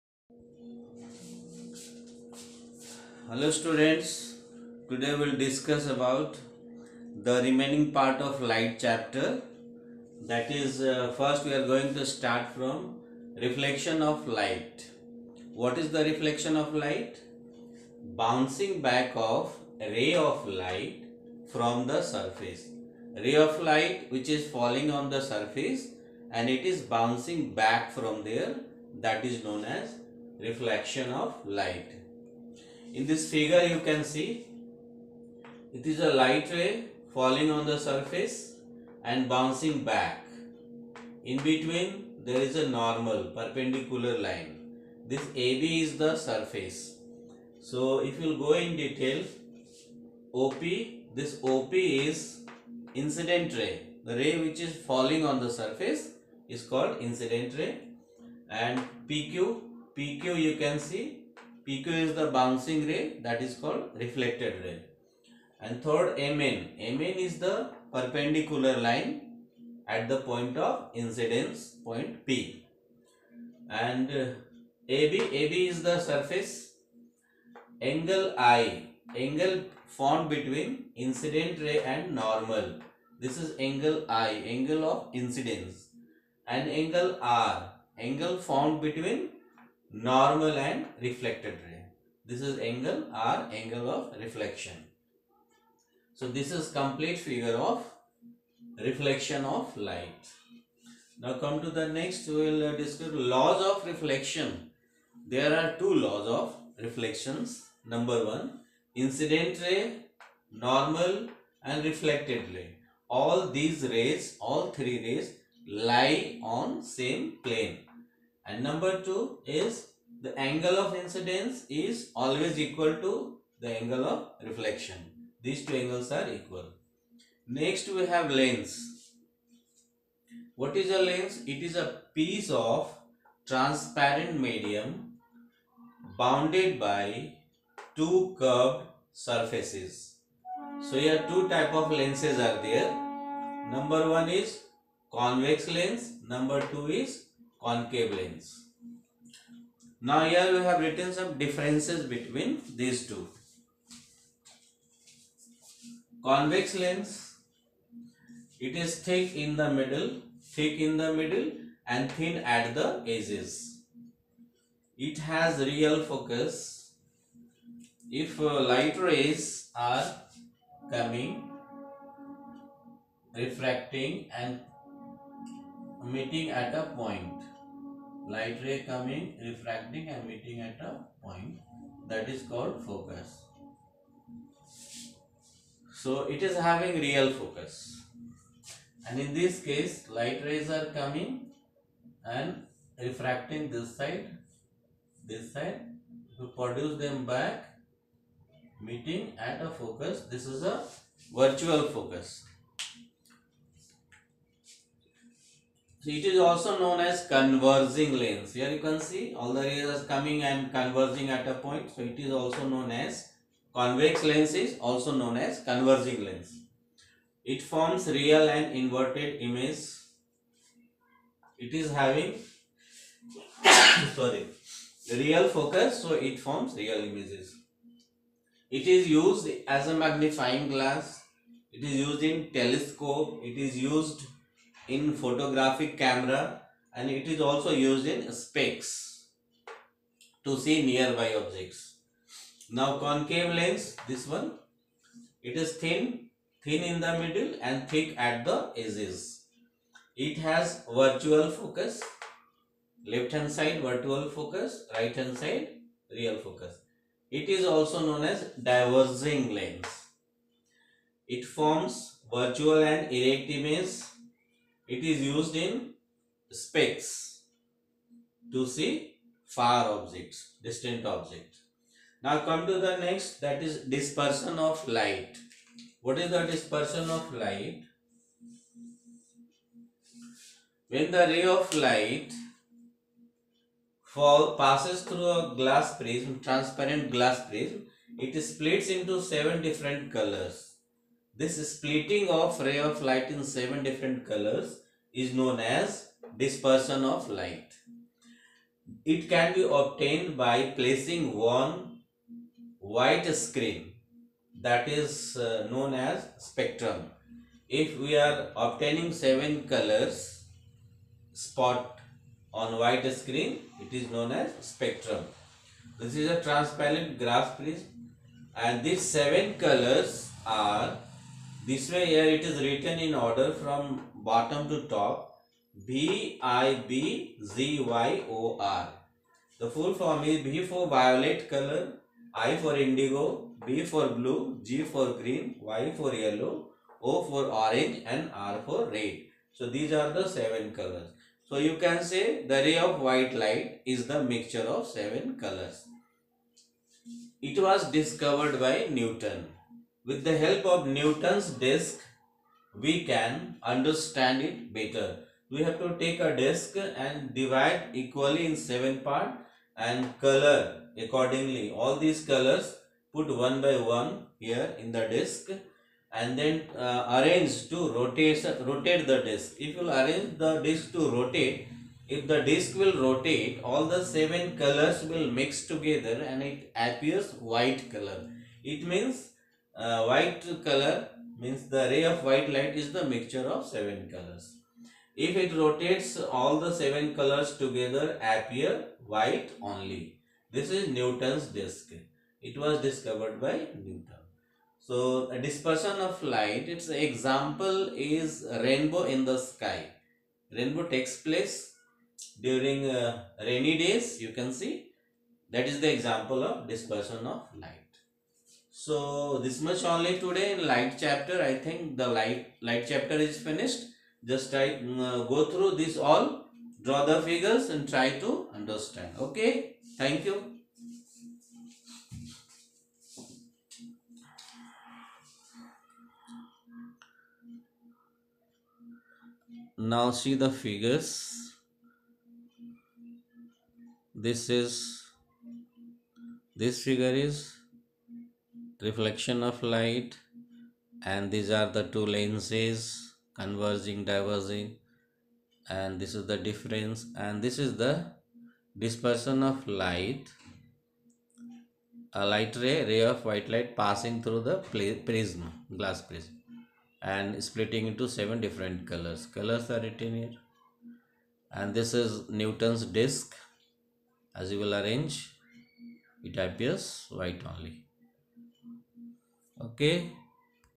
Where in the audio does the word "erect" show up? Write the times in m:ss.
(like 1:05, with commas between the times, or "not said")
4:23.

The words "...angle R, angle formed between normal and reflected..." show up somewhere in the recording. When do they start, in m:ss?
1:26.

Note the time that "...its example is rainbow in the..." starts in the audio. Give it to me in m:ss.
6:36.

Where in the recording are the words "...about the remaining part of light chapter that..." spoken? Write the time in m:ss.
0:05.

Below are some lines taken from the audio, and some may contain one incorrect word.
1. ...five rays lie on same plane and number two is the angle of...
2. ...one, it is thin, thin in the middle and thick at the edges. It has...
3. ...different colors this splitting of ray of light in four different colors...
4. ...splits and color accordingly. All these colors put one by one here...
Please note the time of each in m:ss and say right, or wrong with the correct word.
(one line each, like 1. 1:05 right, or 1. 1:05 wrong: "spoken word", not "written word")
1. 1:54 wrong: "three", not "five"
2. 4:04 right
3. 4:49 wrong: "seven", not "four"
4. 5:59 wrong: "parts", not "splits".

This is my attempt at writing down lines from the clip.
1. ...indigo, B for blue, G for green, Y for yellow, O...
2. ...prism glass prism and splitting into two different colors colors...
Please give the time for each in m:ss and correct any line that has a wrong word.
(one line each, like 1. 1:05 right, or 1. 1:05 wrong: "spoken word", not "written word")
1. 5:32 right
2. 7:35 wrong: "seven", not "two".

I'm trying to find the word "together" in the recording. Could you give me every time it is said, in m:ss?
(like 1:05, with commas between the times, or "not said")
6:15, 6:27.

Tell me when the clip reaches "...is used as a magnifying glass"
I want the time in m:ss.
3:48.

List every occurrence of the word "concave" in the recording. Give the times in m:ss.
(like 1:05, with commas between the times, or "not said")
2:27, 4:02.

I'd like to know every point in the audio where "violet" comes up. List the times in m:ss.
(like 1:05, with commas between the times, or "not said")
5:30.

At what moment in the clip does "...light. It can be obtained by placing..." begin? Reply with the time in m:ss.
4:57.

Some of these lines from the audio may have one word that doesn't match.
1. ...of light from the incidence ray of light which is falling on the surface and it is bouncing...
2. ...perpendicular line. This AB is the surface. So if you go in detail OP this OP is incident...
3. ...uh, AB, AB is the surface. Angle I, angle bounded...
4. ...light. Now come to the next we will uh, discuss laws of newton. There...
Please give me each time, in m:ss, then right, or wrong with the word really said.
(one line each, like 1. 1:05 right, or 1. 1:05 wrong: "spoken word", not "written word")
1. 0:20 wrong: "surface", not "incidence"
2. 0:43 right
3. 1:14 wrong: "formed", not "bounded"
4. 1:39 wrong: "reflection", not "newton".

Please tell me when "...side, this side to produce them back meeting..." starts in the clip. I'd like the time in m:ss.
3:13.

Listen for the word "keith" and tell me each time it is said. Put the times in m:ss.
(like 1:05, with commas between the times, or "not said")
not said.